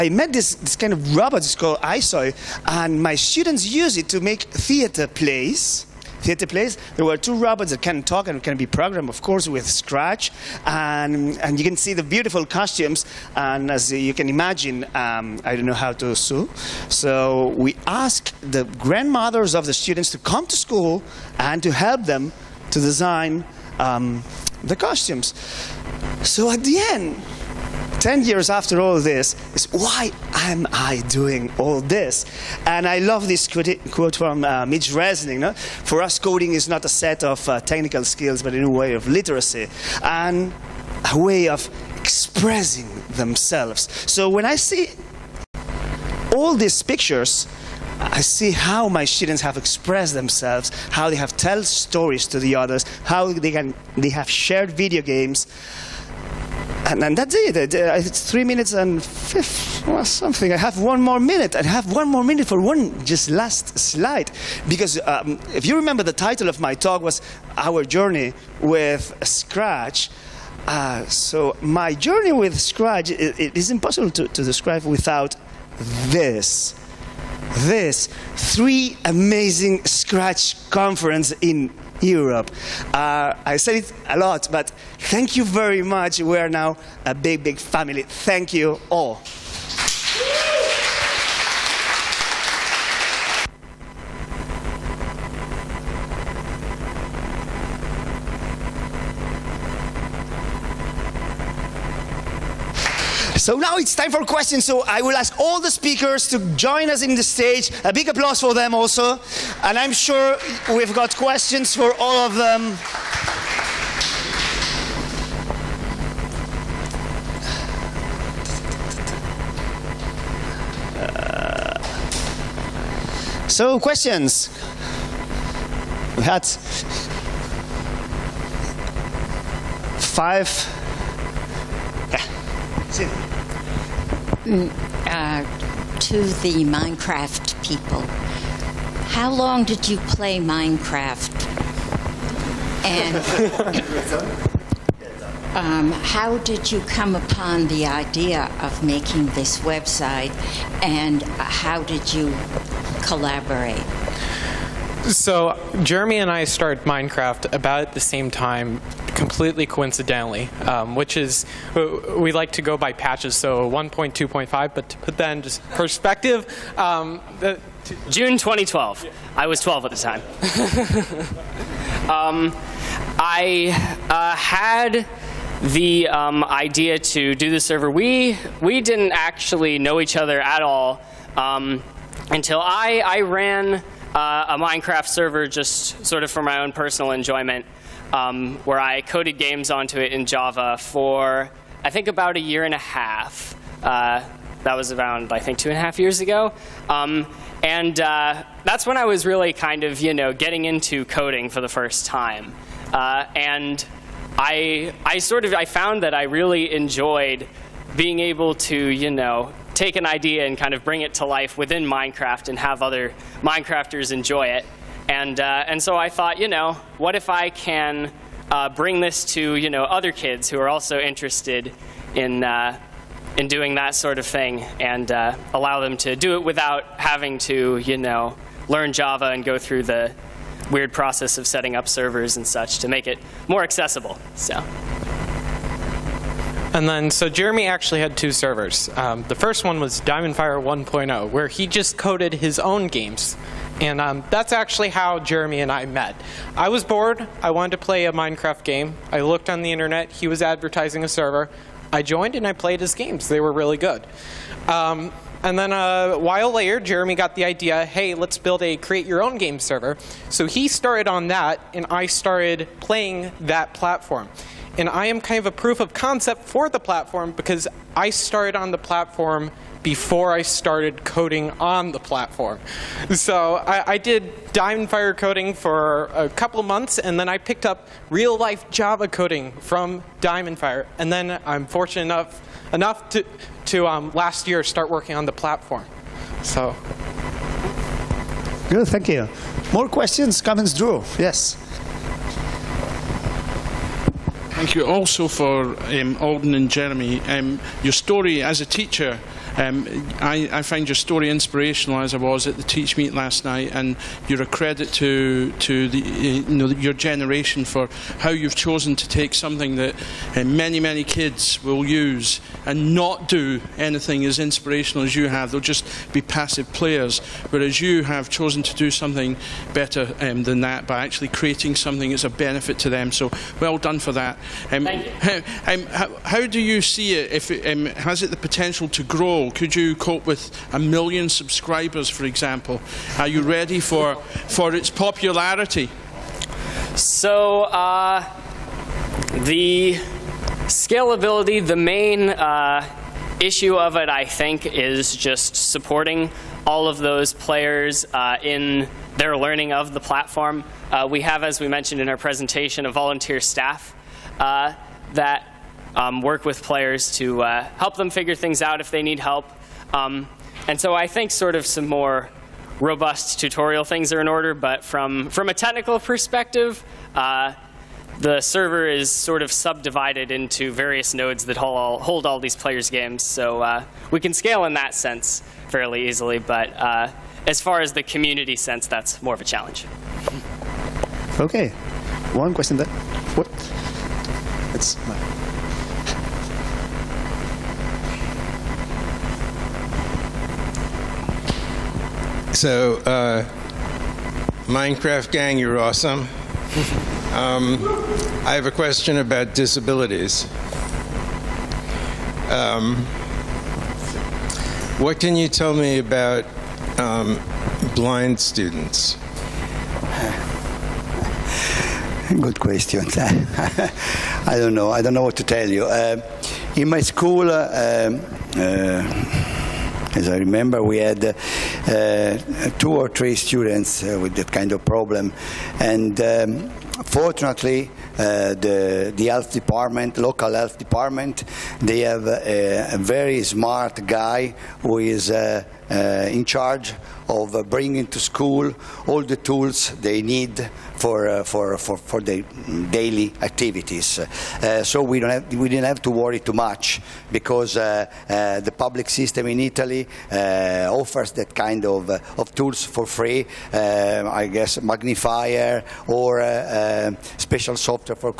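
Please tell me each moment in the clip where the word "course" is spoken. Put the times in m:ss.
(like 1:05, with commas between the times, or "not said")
0:09.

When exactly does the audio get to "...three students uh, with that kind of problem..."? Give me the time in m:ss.
7:03.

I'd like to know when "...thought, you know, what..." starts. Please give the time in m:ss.
3:36.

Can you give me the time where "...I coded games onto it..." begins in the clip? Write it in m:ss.
3:08.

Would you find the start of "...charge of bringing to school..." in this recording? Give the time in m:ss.
7:16.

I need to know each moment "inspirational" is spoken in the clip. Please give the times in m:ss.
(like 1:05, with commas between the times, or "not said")
5:01, 5:14.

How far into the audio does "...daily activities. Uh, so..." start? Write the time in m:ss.
7:22.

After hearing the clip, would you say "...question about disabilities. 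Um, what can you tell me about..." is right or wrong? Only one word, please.
right.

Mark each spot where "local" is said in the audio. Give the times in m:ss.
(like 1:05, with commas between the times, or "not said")
7:10.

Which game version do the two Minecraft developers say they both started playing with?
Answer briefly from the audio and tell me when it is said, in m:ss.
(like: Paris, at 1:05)
1.2.5, at 2:43.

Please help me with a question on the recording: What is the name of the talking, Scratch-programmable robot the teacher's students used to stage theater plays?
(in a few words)
iSoy.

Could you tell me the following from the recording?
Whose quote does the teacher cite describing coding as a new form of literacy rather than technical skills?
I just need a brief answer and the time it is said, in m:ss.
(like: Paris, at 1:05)
Mitch Resnick, at 0:34.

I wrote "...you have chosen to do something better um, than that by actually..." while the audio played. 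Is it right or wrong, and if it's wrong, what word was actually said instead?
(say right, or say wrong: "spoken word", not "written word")
right.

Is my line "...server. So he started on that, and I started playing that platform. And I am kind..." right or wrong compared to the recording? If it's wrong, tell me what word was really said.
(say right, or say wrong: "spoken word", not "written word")
right.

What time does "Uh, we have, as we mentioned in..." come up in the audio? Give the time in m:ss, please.
5:50.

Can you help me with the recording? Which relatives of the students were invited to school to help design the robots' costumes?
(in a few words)
Grandmothers.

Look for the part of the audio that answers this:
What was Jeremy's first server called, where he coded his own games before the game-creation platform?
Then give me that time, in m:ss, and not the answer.
3:59.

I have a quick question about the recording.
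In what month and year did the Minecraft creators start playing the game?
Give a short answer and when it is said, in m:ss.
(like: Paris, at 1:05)
June 2012, at 2:48.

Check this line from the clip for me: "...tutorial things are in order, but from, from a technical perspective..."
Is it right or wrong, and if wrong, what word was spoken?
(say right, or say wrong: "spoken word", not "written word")
right.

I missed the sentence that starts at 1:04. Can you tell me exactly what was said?
Because um, if you remember, the title of my talk was Our Journey with Scratch.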